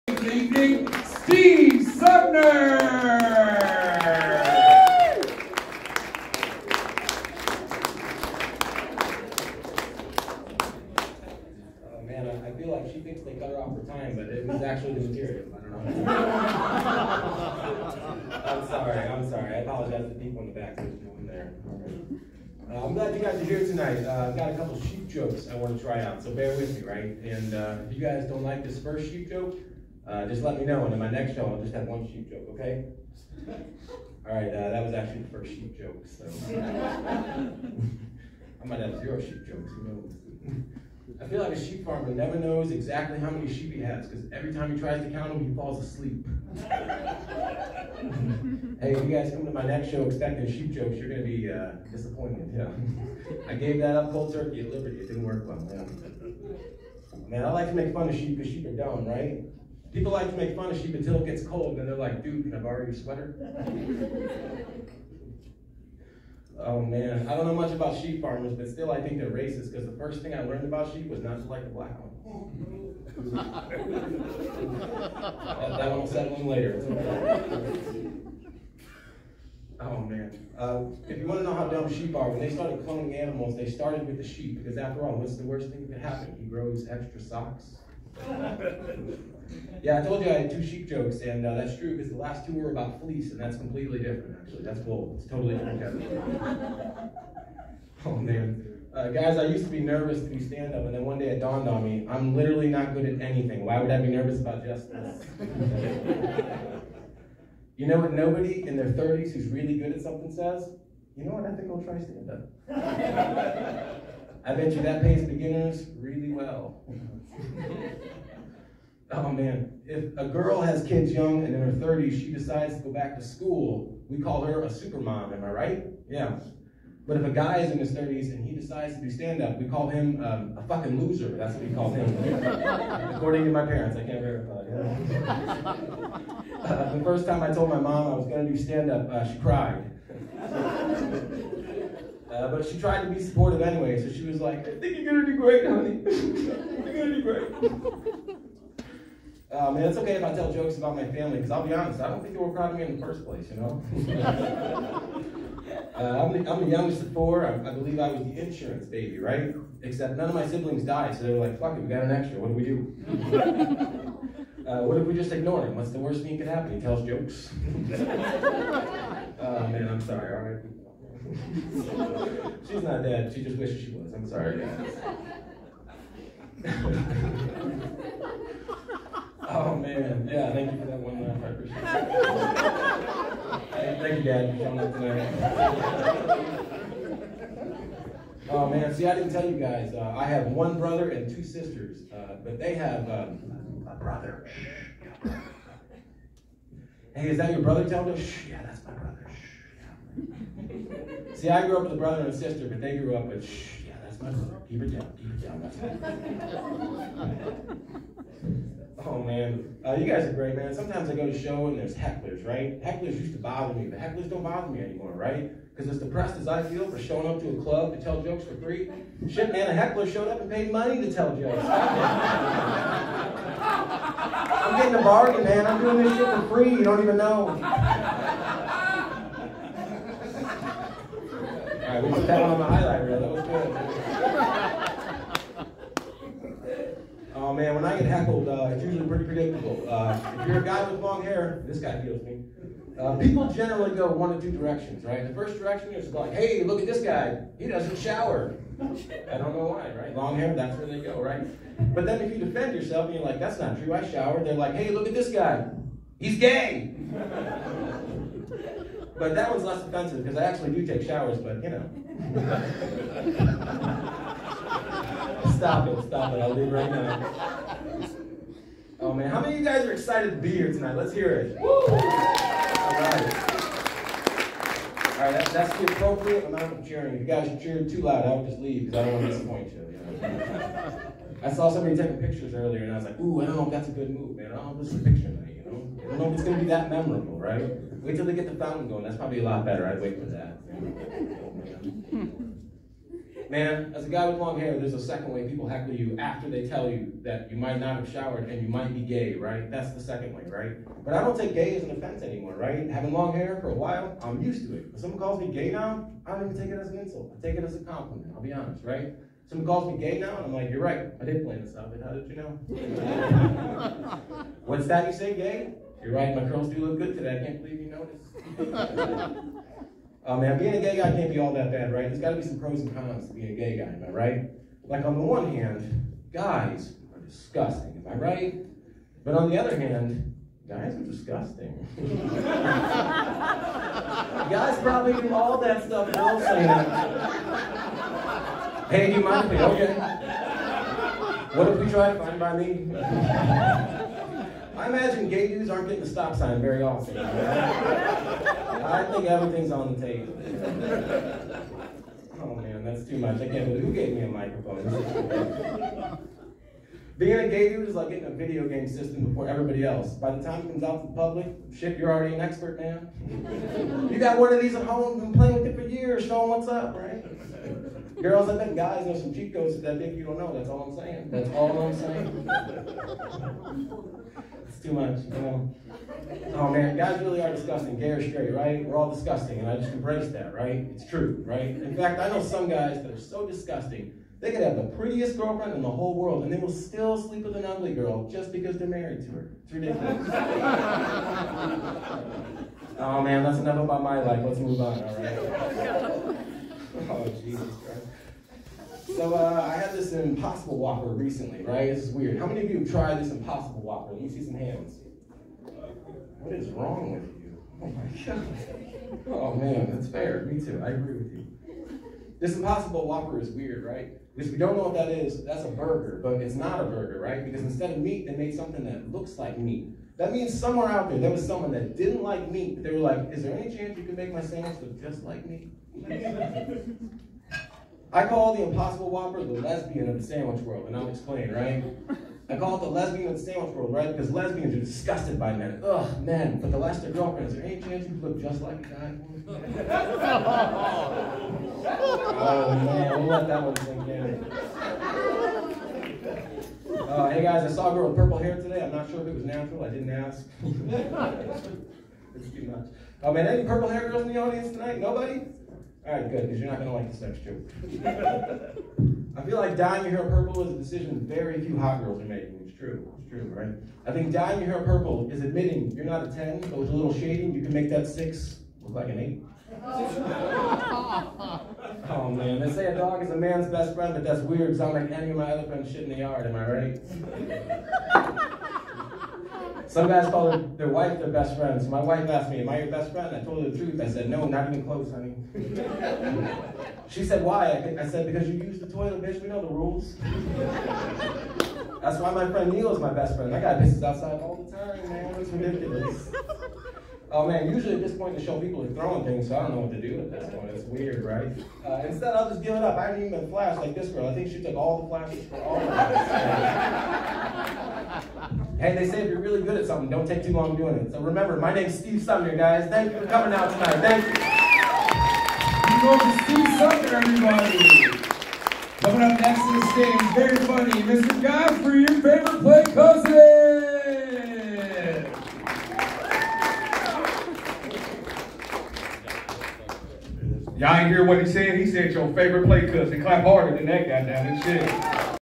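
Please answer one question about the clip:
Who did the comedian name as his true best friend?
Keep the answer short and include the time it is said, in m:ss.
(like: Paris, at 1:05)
Neil, at 8:12.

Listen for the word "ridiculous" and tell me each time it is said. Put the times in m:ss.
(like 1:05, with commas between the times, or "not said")
6:29, 8:15.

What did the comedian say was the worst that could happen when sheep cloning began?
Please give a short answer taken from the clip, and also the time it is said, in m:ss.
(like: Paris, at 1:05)
extra socks, at 1:26.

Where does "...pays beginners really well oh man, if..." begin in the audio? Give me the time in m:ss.
1:55.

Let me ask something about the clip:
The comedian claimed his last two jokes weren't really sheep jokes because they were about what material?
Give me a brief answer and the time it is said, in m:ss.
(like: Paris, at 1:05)
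fleece, at 1:33.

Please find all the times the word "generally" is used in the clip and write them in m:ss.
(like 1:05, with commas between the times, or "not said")
4:03.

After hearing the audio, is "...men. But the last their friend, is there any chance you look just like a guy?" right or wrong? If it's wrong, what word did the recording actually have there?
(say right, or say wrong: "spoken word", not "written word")
wrong: "girlfriend", not "friend".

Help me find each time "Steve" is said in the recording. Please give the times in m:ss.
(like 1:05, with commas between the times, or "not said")
0:01, 8:31, 8:36.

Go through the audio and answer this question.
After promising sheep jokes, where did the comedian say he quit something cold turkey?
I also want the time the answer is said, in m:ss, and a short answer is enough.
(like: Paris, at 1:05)
Liberty, at 0:54.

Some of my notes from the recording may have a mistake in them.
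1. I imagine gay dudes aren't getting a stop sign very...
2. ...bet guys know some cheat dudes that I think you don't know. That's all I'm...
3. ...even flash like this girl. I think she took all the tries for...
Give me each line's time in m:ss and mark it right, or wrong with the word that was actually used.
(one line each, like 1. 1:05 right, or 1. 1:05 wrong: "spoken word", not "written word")
1. 5:44 right
2. 6:08 wrong: "codes", not "dudes"
3. 8:23 wrong: "flashes", not "tries".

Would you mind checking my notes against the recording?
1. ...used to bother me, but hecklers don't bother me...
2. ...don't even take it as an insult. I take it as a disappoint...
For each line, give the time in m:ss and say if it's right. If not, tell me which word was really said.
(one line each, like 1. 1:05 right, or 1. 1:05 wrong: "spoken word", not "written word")
1. 3:33 right
2. 5:06 wrong: "compliment", not "disappoint".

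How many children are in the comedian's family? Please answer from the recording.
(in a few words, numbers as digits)
4.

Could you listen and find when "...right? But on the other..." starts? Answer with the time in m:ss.
5:28.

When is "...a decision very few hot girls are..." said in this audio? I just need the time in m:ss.
7:40.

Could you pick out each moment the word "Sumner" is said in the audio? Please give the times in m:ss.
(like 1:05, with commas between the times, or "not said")
0:01, 8:32, 8:36.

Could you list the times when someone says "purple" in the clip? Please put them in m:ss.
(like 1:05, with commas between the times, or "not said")
7:28, 7:33, 7:40, 7:44.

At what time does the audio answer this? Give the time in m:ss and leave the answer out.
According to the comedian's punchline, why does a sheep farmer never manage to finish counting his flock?
0:45.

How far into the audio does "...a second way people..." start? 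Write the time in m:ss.
4:54.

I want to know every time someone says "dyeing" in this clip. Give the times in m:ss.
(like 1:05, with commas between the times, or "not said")
7:39, 7:44.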